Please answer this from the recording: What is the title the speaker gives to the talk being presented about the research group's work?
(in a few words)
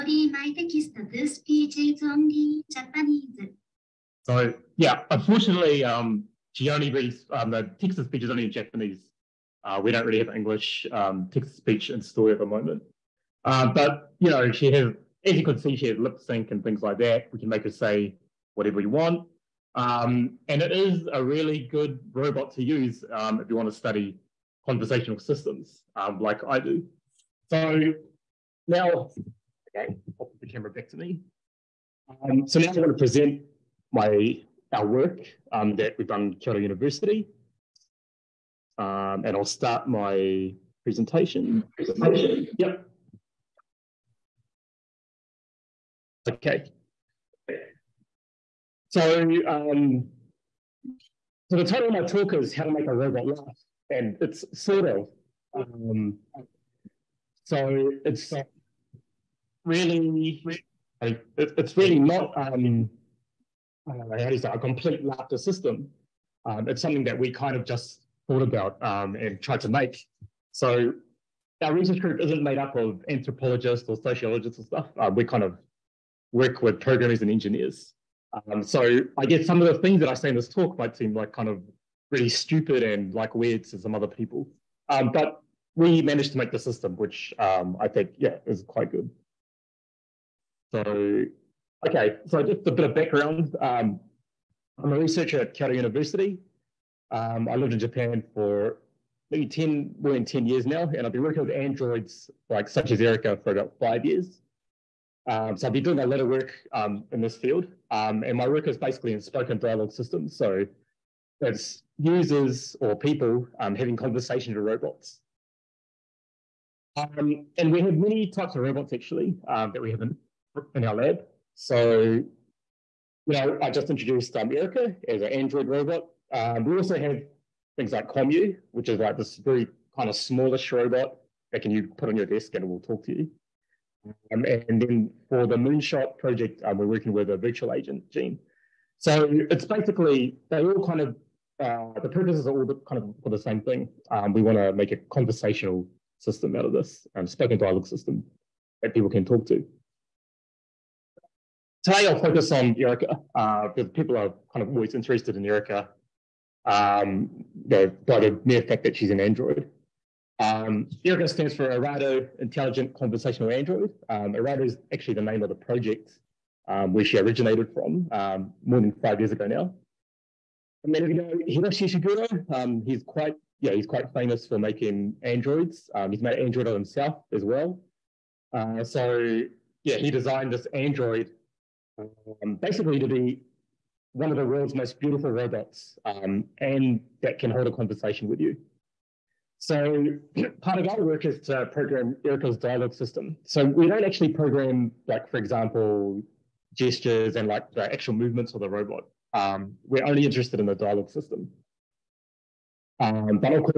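How to Make a Robot Laugh.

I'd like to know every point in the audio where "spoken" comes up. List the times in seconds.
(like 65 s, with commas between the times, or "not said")
109 s, 147 s.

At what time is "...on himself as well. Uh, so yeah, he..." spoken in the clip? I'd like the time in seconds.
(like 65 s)
176 s.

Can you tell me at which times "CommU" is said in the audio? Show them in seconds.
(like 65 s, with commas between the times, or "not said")
128 s.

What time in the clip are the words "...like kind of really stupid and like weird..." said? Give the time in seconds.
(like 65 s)
81 s.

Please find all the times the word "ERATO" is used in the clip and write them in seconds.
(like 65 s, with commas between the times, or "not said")
161 s.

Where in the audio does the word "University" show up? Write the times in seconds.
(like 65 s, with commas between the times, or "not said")
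36 s, 95 s.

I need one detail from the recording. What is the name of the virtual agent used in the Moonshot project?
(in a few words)
Gene.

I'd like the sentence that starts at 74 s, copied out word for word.
Uh, we kind of work with programmers and engineers.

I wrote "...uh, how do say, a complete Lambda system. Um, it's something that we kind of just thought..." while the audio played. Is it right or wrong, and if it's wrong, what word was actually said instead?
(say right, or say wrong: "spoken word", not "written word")
right.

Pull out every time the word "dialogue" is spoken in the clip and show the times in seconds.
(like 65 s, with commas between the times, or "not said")
109 s, 147 s, 192 s, 200 s.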